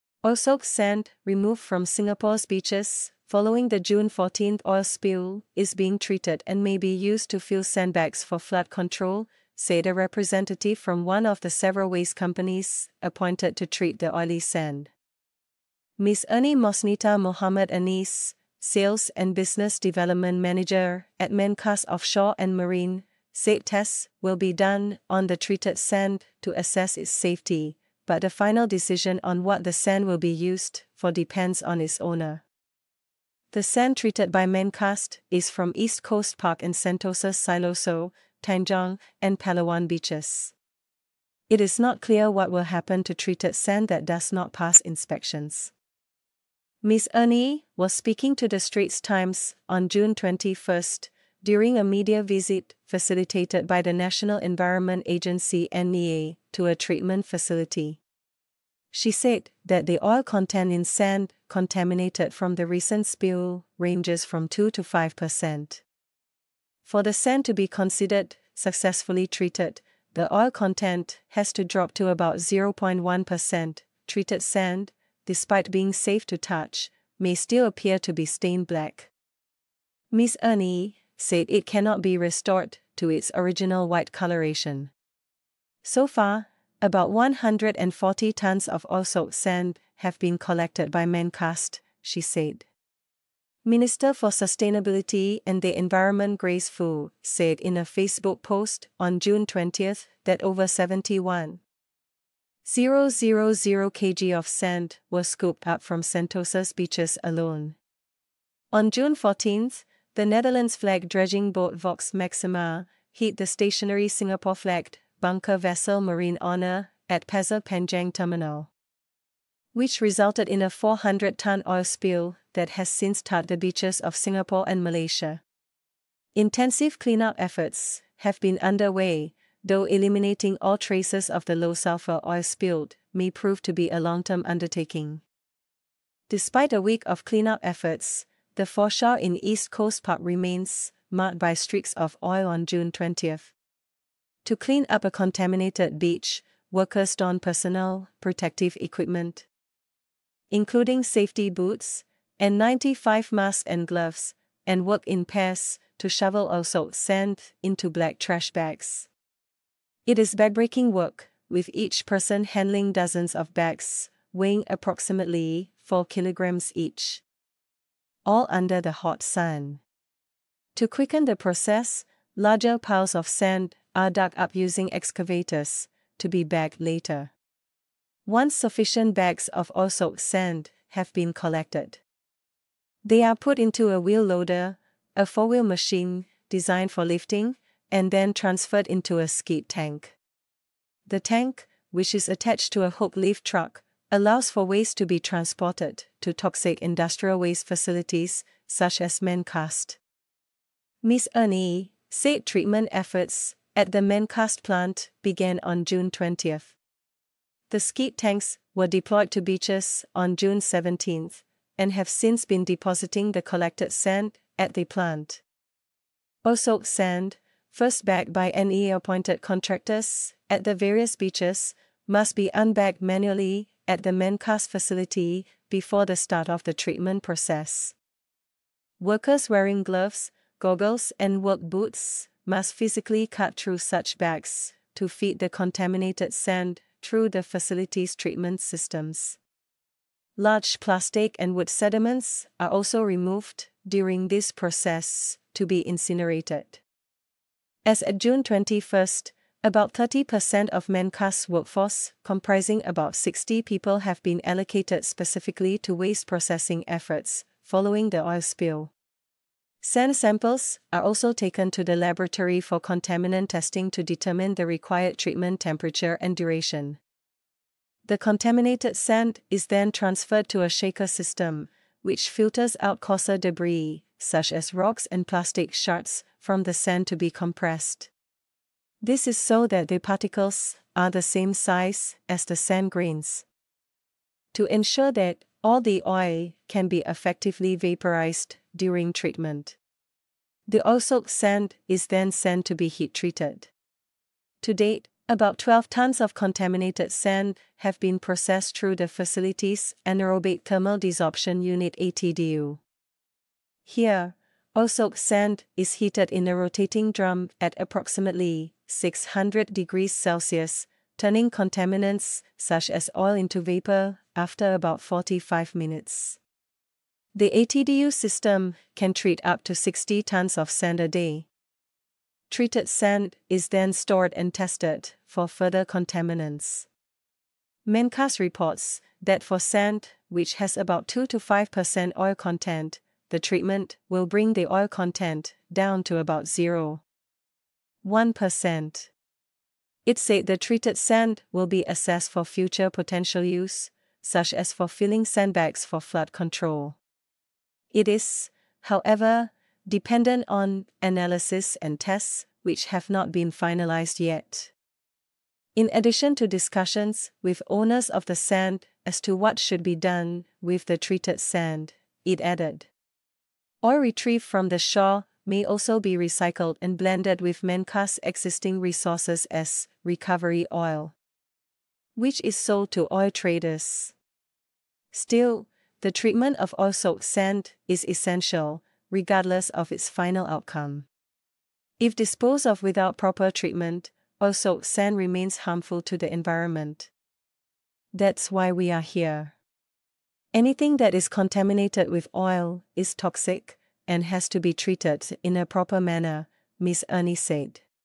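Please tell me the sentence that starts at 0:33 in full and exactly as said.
The sand treated by Mencast is from East Coast Park in Sentosa, Siloso, Tanjong, and Palawan beaches.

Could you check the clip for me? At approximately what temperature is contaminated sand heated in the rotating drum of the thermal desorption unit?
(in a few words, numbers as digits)
600 degrees Celsius.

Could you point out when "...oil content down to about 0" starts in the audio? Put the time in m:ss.
5:34.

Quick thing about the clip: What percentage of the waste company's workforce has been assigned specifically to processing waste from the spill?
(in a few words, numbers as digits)
30%.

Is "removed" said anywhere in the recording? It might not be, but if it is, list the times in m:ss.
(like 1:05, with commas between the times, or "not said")
0:01, 4:03.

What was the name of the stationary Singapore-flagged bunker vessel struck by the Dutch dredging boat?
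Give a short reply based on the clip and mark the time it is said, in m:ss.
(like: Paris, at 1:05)
Marine Honor, at 1:56.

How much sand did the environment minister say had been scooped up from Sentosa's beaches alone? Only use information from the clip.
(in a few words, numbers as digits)
over 71,000 kg.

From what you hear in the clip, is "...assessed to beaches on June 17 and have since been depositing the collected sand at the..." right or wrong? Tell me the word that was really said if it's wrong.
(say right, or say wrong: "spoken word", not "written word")
wrong: "deployed", not "assessed".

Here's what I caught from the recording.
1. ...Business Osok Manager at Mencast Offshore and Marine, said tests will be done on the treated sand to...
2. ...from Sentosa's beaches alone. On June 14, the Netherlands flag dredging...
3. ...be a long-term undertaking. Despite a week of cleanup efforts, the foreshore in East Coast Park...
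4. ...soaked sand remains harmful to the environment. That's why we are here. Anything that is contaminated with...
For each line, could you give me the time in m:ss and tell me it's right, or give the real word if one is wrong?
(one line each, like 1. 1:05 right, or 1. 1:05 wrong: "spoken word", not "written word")
1. 0:19 wrong: "Development", not "Osok"
2. 1:45 right
3. 2:13 right
4. 6:24 right.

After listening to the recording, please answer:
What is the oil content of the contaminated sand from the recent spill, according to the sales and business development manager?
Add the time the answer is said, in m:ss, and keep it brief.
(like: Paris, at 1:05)
2 to 5 percent, at 1:04.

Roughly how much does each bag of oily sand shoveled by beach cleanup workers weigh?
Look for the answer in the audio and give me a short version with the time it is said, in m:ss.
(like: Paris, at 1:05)
4 kilograms, at 2:45.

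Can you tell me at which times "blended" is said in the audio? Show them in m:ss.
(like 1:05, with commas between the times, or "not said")
6:06.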